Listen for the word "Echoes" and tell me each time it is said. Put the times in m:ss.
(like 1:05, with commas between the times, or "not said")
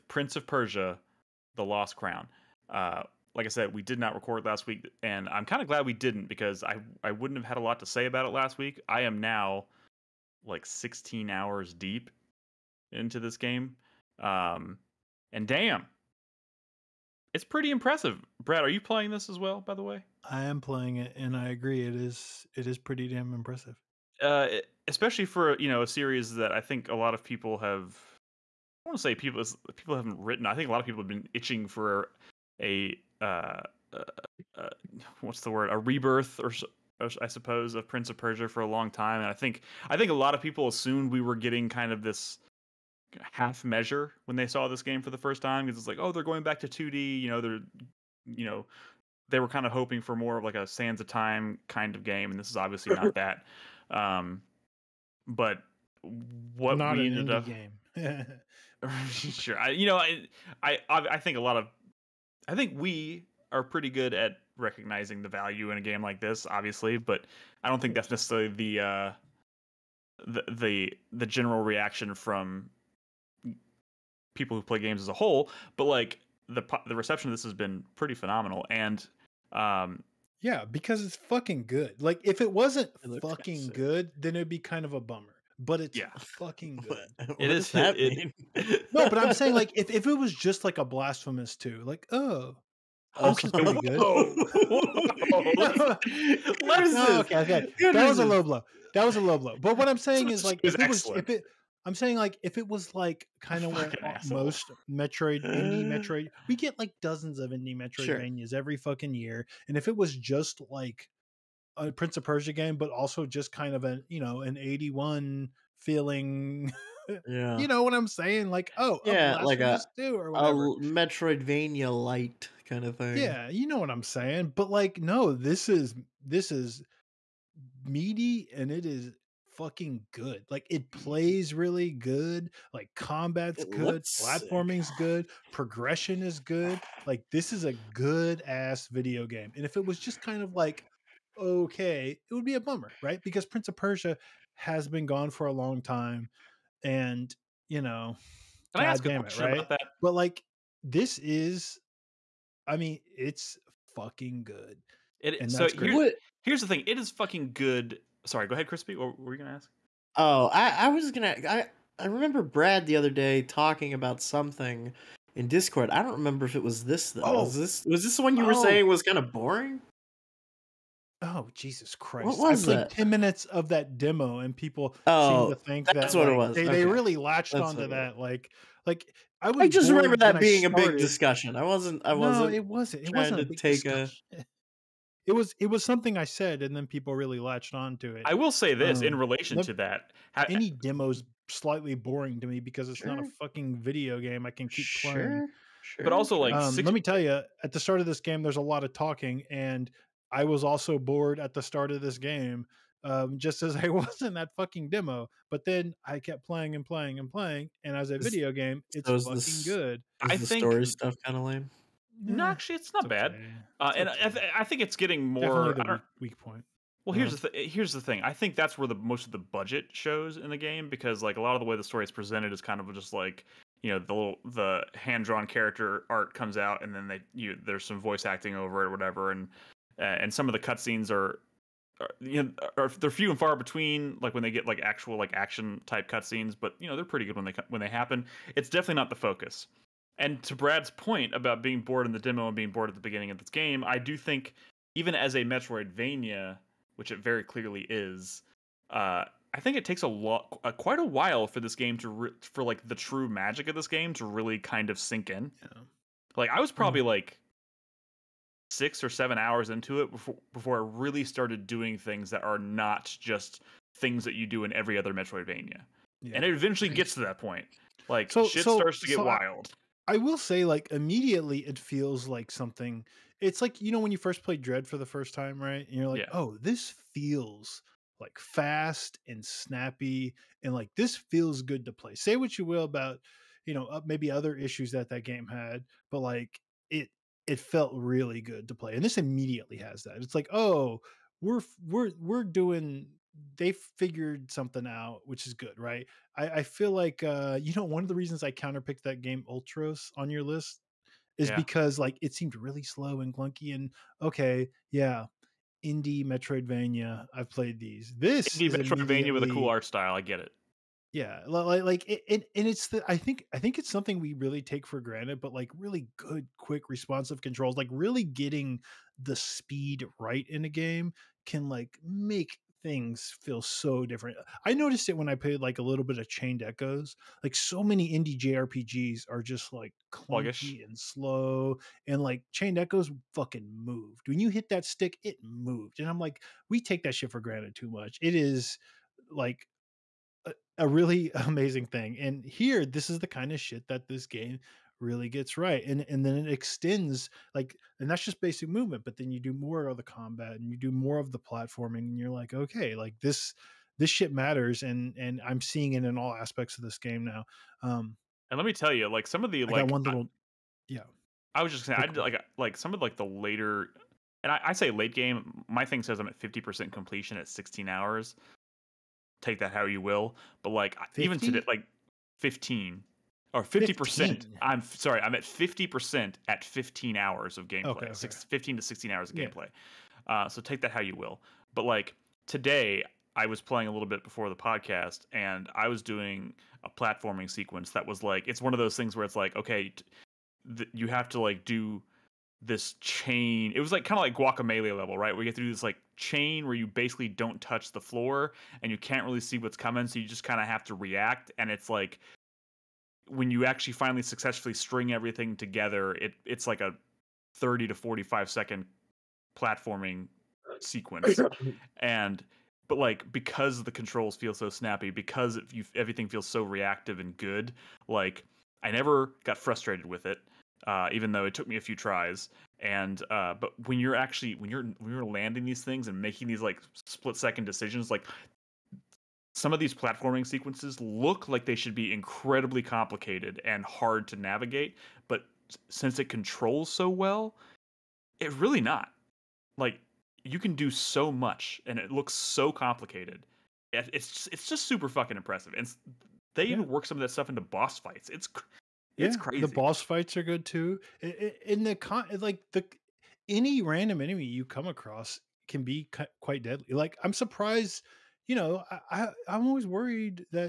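5:26, 5:32.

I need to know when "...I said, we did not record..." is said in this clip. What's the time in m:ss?
0:03.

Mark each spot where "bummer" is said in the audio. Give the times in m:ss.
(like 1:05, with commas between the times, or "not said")
1:24, 2:22.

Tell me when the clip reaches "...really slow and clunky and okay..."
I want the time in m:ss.
5:02.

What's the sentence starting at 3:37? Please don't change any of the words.
here's the th- here's the thing.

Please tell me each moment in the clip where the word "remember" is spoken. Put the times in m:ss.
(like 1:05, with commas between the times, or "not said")
2:42, 2:46, 2:59.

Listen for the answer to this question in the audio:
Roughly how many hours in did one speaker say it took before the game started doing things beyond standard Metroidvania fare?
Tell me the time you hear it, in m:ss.
4:18.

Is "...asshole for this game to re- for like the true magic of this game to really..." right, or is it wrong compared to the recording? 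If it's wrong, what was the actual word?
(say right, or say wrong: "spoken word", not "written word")
wrong: "while", not "asshole".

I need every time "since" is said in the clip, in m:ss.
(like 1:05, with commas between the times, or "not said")
7:15.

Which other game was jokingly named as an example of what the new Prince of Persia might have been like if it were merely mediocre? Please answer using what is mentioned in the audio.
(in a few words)
Blasphemous 2.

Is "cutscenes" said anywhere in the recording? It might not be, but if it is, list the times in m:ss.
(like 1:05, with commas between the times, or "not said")
3:50, 3:56.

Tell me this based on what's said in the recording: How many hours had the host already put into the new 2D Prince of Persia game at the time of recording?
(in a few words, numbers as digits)
16.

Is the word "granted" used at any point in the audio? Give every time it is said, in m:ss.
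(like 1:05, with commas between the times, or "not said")
5:14, 5:37.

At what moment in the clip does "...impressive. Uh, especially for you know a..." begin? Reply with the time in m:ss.
0:23.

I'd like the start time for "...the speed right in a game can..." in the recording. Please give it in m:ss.
5:19.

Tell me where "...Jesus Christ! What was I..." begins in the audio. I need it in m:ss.
2:51.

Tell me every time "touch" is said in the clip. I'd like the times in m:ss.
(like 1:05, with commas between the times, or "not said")
6:37.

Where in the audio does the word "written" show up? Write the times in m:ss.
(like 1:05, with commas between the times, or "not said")
0:30.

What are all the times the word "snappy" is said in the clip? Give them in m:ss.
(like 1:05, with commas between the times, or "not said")
4:39, 6:54.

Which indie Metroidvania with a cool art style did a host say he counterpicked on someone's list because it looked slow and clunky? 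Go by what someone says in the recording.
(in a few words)
Ultros.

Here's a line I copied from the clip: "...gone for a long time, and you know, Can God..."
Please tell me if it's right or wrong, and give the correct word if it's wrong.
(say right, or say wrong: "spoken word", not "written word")
right.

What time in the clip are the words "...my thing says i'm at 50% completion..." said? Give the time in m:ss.
6:05.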